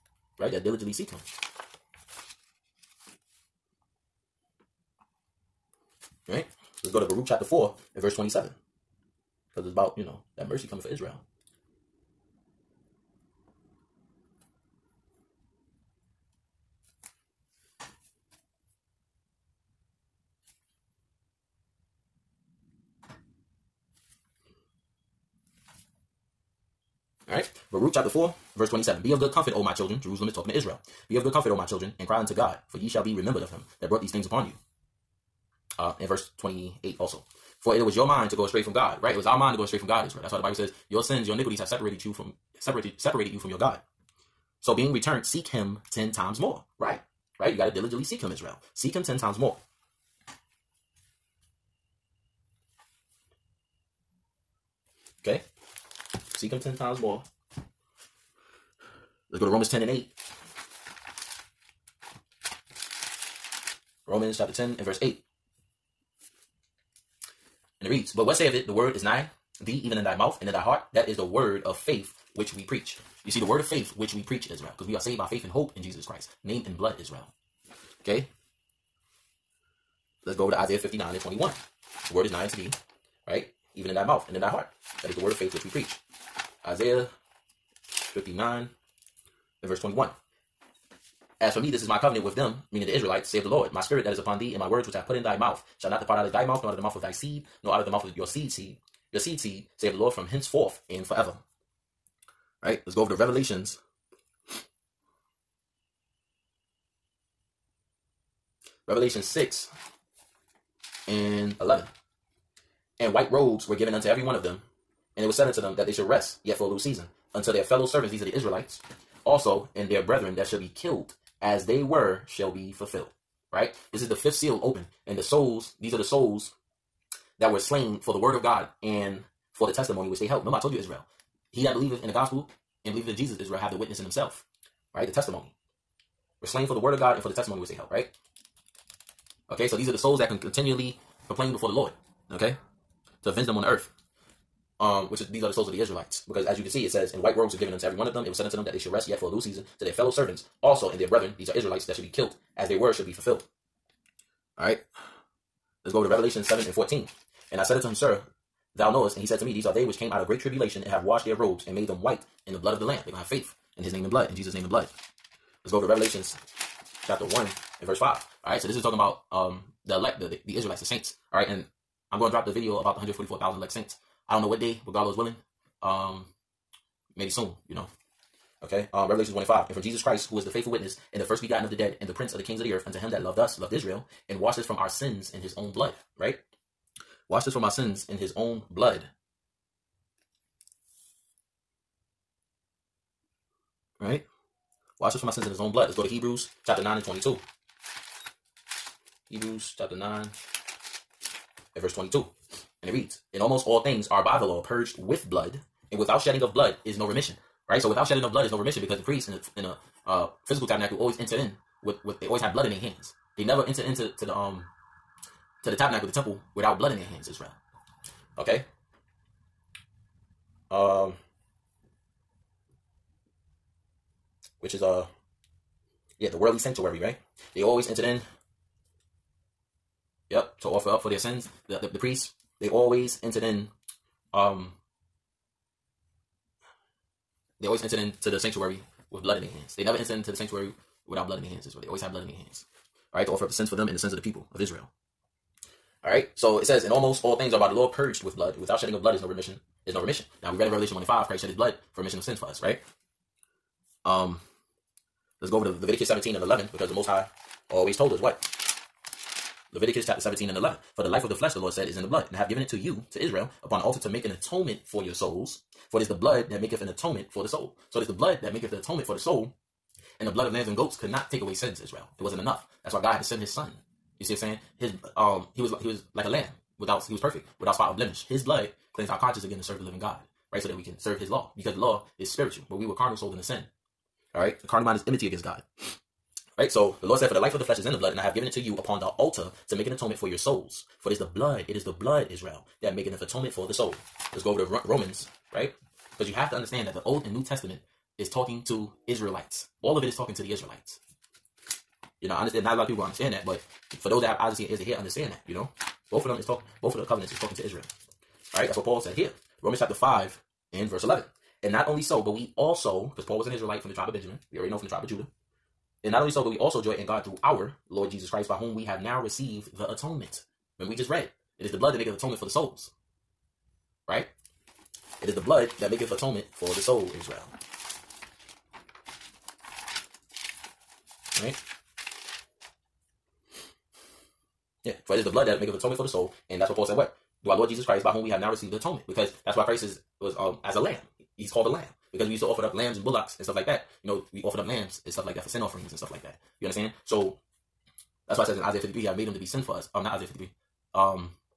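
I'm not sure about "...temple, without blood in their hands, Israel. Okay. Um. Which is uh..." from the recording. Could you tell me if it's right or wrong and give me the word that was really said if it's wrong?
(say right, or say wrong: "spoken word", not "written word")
right.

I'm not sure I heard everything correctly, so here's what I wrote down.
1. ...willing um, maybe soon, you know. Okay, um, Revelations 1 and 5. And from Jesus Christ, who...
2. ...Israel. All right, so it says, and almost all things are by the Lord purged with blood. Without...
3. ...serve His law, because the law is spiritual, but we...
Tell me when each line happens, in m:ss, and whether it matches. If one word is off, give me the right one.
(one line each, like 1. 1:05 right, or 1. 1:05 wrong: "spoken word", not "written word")
1. 2:55 right
2. 4:04 right
3. 4:40 right.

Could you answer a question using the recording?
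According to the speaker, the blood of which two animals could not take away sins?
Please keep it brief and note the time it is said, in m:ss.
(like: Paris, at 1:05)
lambs and goats, at 4:30.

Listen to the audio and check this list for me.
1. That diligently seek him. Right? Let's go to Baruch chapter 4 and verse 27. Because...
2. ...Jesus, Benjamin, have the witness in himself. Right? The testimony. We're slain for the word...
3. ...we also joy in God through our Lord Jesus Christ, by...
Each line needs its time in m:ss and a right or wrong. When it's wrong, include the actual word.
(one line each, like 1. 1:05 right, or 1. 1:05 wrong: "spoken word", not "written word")
1. 0:00 right
2. 2:13 wrong: "Israel", not "Benjamin"
3. 5:16 right.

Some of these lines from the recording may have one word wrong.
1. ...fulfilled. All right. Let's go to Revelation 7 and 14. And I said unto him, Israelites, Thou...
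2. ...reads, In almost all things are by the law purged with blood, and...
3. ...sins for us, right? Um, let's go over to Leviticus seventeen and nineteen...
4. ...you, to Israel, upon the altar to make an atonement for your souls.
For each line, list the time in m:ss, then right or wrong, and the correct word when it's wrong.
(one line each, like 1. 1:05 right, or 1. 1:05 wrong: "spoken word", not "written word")
1. 2:33 wrong: "Sir", not "Israelites"
2. 3:22 right
3. 4:12 wrong: "eleven", not "nineteen"
4. 4:22 right.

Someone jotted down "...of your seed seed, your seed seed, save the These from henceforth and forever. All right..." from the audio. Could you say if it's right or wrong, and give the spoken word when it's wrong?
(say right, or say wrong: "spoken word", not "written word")
wrong: "Lord", not "These".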